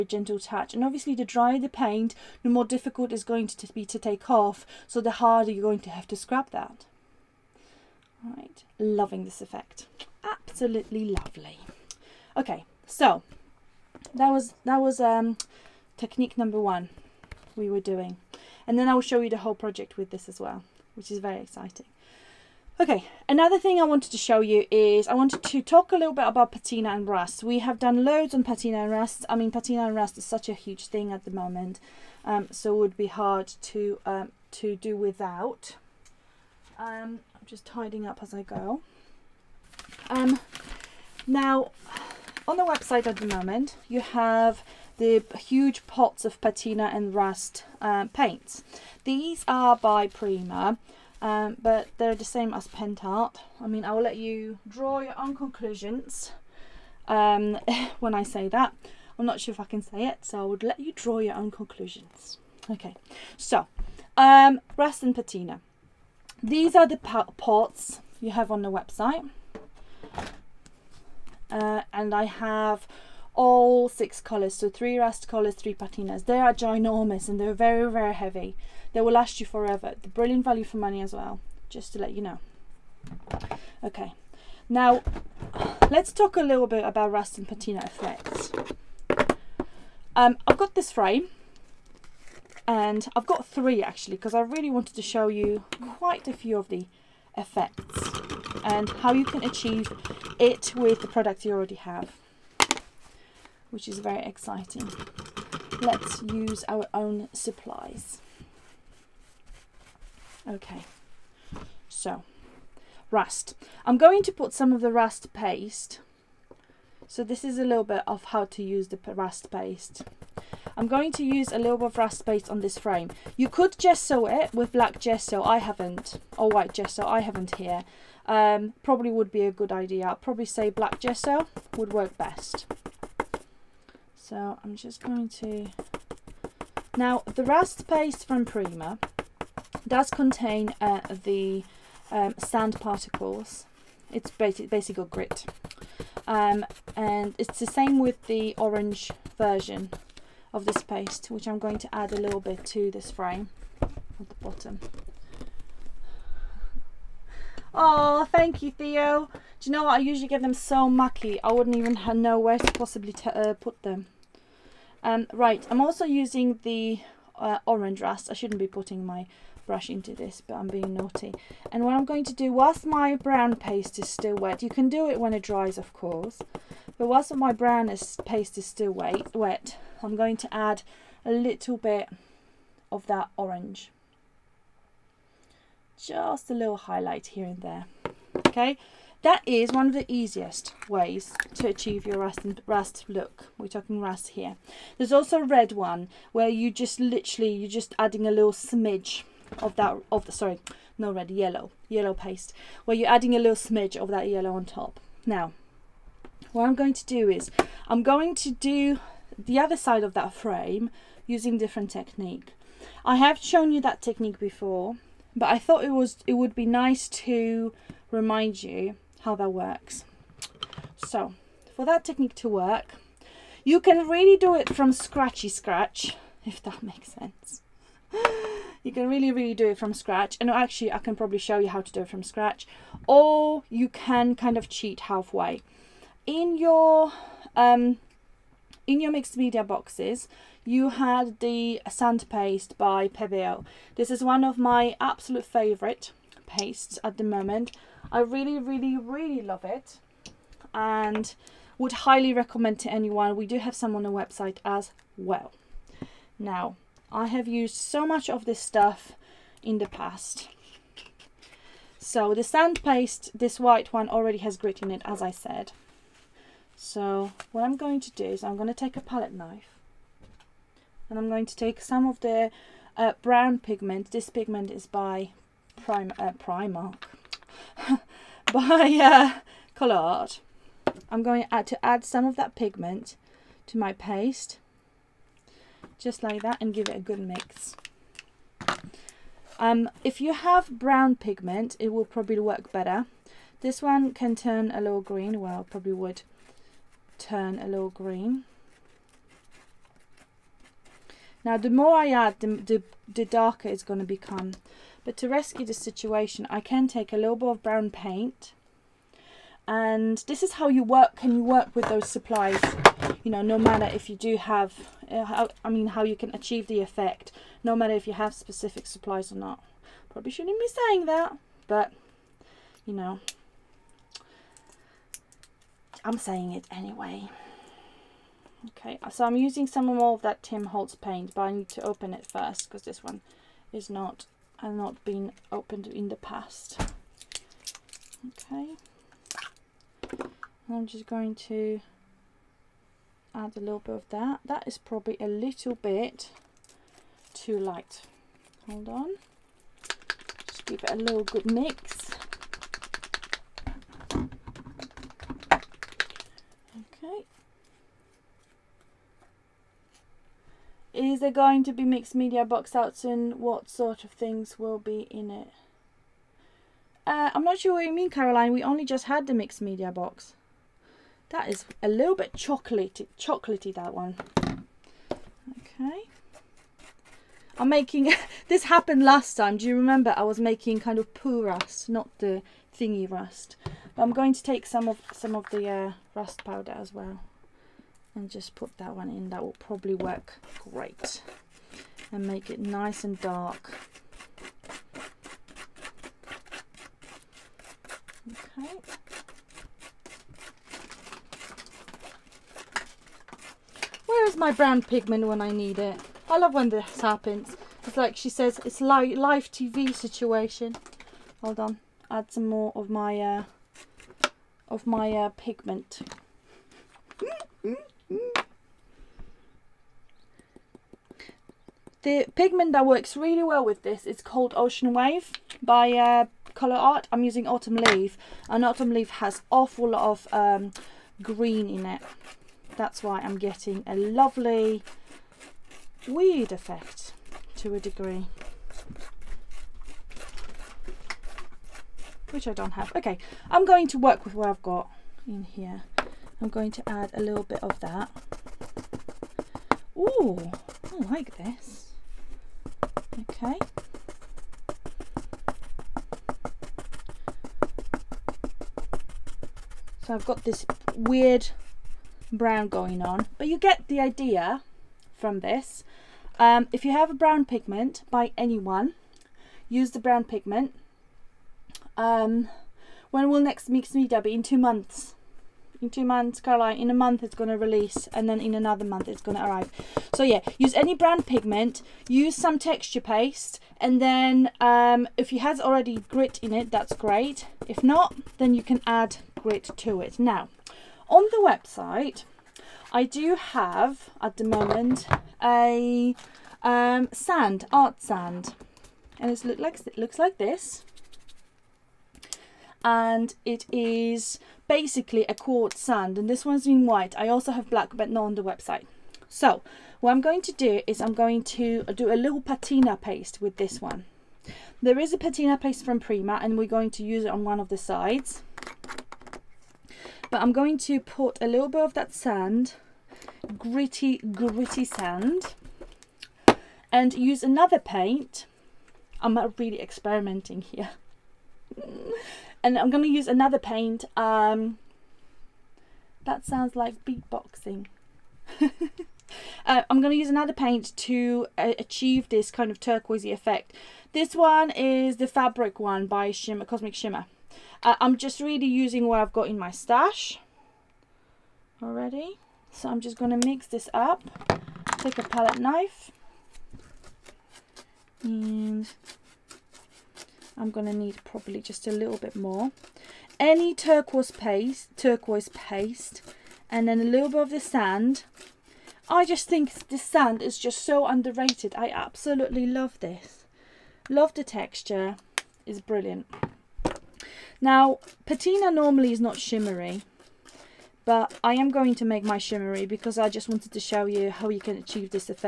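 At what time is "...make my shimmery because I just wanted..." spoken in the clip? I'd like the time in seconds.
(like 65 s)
582 s.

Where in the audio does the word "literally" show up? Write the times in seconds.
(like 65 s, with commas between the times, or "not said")
196 s.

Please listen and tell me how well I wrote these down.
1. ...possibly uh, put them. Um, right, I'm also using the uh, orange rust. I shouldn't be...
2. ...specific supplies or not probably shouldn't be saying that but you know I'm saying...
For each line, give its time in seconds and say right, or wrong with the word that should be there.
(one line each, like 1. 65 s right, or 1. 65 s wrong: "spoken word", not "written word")
1. 162 s right
2. 318 s right.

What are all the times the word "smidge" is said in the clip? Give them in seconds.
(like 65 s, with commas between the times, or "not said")
198 s, 203 s.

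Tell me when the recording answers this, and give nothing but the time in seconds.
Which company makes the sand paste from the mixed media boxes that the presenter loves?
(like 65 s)
241 s.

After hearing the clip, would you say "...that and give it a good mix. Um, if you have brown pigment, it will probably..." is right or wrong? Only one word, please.
right.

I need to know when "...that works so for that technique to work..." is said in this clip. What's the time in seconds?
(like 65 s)
219 s.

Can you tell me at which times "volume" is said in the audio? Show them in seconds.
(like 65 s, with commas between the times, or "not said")
not said.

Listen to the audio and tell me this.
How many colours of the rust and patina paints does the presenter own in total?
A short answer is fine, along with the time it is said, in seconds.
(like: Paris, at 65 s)
6, at 72 s.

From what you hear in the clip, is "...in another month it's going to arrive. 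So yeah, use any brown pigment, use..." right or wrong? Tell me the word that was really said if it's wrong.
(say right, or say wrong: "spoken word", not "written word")
right.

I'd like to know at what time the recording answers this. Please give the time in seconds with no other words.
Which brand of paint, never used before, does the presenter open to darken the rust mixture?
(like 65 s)
330 s.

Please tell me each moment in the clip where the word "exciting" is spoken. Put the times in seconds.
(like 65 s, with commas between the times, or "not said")
21 s, 104 s.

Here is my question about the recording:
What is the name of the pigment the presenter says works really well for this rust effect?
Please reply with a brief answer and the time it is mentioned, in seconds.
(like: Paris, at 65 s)
Ocean Wave, at 424 s.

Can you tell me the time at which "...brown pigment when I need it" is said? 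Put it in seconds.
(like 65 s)
404 s.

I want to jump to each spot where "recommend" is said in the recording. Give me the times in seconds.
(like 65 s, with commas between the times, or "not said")
252 s.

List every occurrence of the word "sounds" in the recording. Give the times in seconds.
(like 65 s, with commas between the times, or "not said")
536 s.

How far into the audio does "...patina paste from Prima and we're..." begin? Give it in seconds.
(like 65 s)
515 s.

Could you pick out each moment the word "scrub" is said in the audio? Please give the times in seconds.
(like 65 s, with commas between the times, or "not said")
6 s.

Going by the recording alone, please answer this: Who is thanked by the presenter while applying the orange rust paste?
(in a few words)
Theo.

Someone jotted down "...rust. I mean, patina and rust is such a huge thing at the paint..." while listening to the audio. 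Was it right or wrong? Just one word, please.
wrong.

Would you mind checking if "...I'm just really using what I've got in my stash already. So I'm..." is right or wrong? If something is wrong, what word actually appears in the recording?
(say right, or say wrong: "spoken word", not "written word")
right.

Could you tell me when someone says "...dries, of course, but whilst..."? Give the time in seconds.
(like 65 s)
175 s.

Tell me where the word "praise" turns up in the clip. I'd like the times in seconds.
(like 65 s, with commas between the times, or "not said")
not said.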